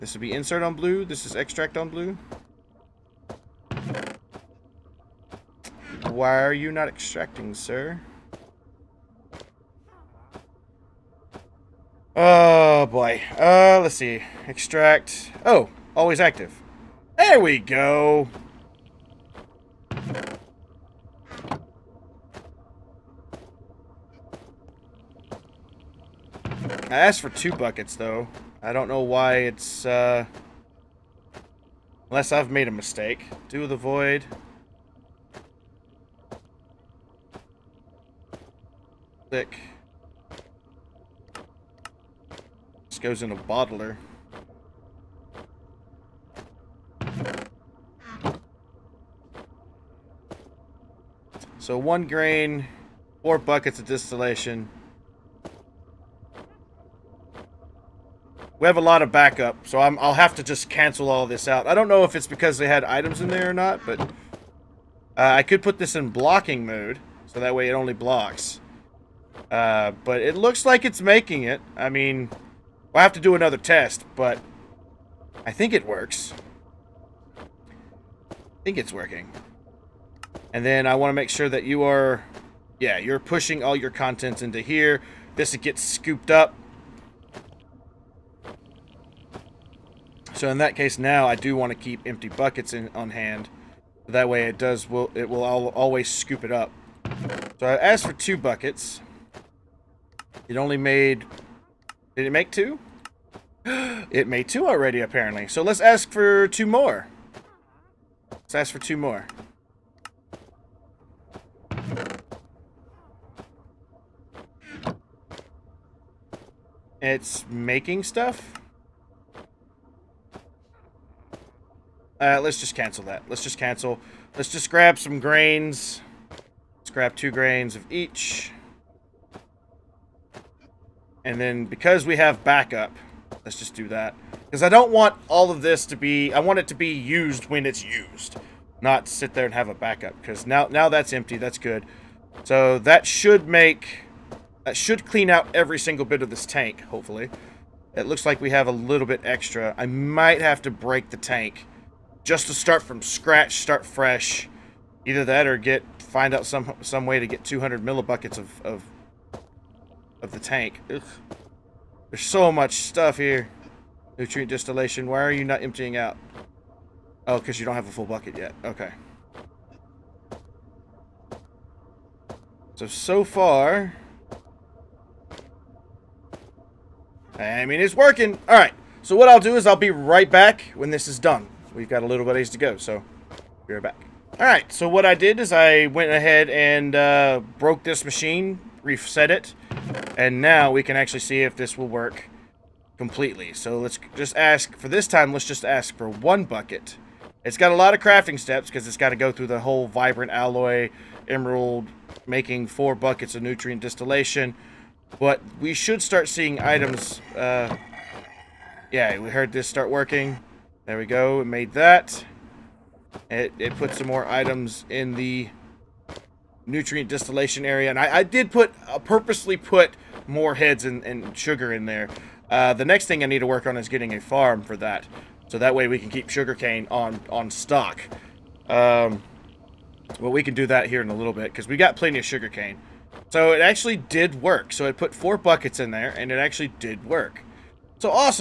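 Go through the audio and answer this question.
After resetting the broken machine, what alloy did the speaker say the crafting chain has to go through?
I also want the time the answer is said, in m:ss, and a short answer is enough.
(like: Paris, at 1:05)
Vibrant alloy, at 3:19.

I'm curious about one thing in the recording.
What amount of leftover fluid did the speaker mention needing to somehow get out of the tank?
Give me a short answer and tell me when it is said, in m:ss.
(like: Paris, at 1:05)
200 millibuckets, at 2:37.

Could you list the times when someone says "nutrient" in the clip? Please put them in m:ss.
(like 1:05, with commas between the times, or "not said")
2:44, 3:23, 3:36.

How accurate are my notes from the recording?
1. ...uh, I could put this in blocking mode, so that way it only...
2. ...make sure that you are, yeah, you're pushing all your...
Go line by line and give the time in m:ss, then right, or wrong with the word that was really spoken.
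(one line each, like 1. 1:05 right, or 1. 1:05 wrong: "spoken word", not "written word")
1. 1:03 right
2. 1:21 right.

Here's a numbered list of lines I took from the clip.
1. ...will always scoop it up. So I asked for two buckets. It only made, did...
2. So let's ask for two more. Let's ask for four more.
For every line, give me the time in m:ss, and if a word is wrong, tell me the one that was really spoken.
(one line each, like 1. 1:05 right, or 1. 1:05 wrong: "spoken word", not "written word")
1. 1:35 right
2. 1:45 wrong: "two", not "four".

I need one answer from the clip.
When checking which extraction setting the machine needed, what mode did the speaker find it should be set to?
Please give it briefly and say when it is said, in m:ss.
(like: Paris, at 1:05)
Always active, at 0:15.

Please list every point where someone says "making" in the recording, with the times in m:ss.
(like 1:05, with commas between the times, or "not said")
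1:11, 1:57, 3:22.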